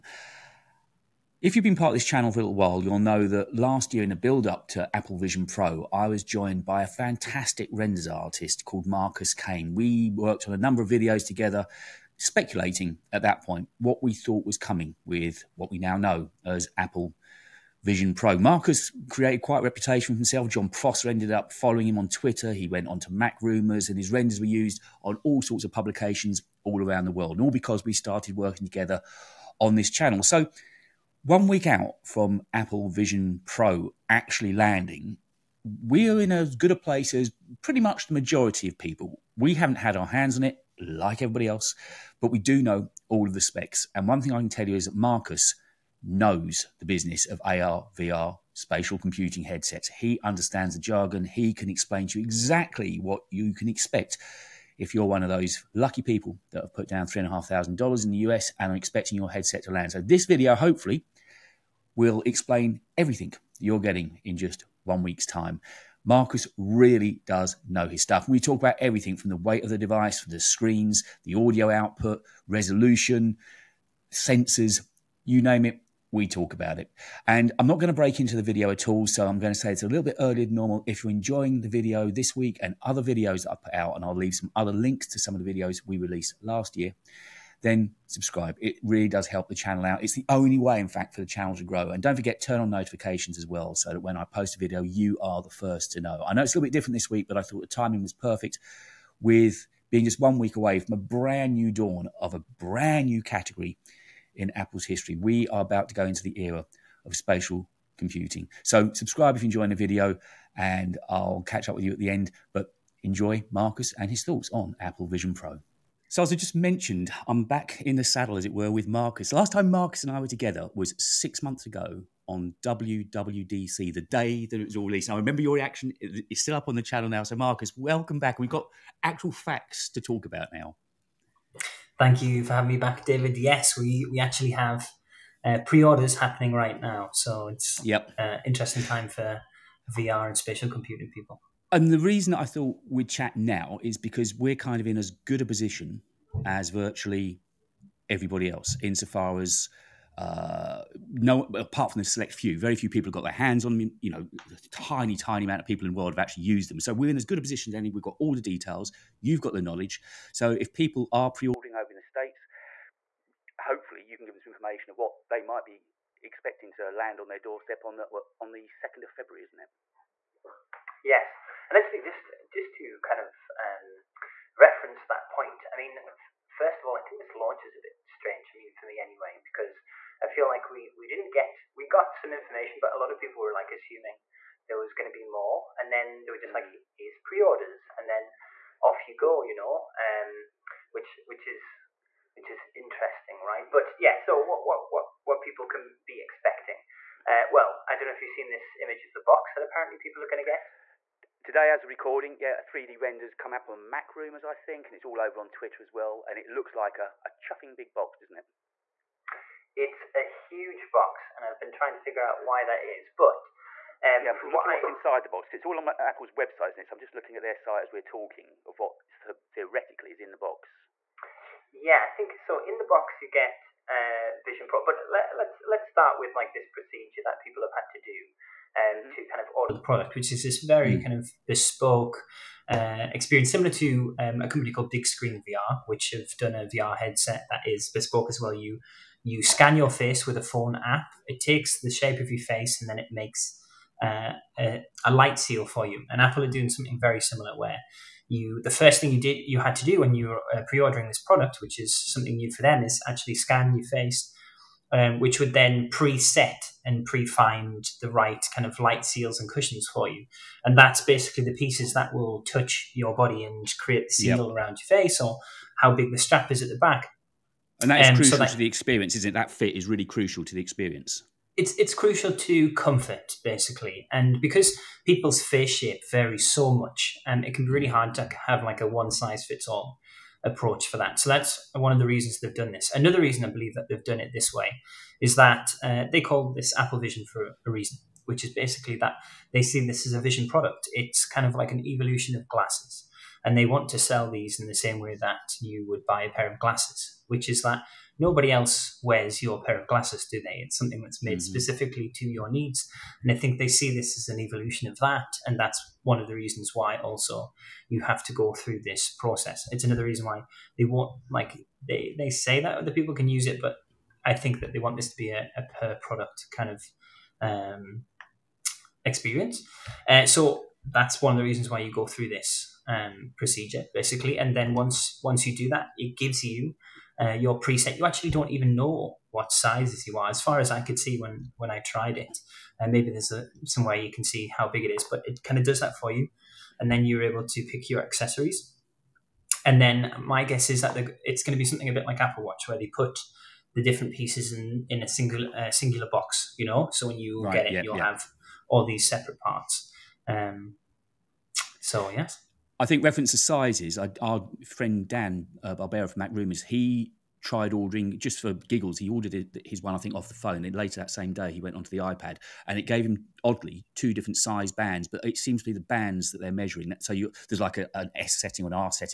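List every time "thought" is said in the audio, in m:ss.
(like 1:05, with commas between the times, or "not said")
0:14, 1:37, 1:54, 2:22.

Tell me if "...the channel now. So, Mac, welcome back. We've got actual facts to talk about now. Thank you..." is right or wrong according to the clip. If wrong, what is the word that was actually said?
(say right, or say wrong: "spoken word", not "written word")
wrong: "Marcus", not "Mac".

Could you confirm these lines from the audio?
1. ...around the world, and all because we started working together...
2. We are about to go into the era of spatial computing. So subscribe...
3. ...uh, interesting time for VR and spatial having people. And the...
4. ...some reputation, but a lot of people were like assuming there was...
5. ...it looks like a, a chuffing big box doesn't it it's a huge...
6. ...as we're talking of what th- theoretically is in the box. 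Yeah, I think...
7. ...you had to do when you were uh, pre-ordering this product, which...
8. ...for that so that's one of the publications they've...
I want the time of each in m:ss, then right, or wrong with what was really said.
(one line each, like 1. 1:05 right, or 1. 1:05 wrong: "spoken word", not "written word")
1. 0:26 right
2. 1:45 right
3. 2:18 wrong: "computing", not "having"
4. 3:02 wrong: "information", not "reputation"
5. 3:26 right
6. 3:37 right
7. 4:09 right
8. 4:40 wrong: "reasons", not "publications".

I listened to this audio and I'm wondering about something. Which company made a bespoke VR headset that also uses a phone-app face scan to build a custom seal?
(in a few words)
Big Screen VR.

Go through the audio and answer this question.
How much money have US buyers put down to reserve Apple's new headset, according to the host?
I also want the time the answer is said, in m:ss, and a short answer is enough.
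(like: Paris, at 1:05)
$3,500, at 0:57.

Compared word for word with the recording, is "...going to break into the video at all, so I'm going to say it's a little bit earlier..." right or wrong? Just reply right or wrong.
right.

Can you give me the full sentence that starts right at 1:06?
Marcus really does know his stuff.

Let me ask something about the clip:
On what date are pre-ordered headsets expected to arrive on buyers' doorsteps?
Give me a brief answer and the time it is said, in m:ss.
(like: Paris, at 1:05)
2 February, at 2:48.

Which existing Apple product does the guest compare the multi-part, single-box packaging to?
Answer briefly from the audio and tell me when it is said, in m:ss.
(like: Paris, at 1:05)
Apple Watch, at 5:42.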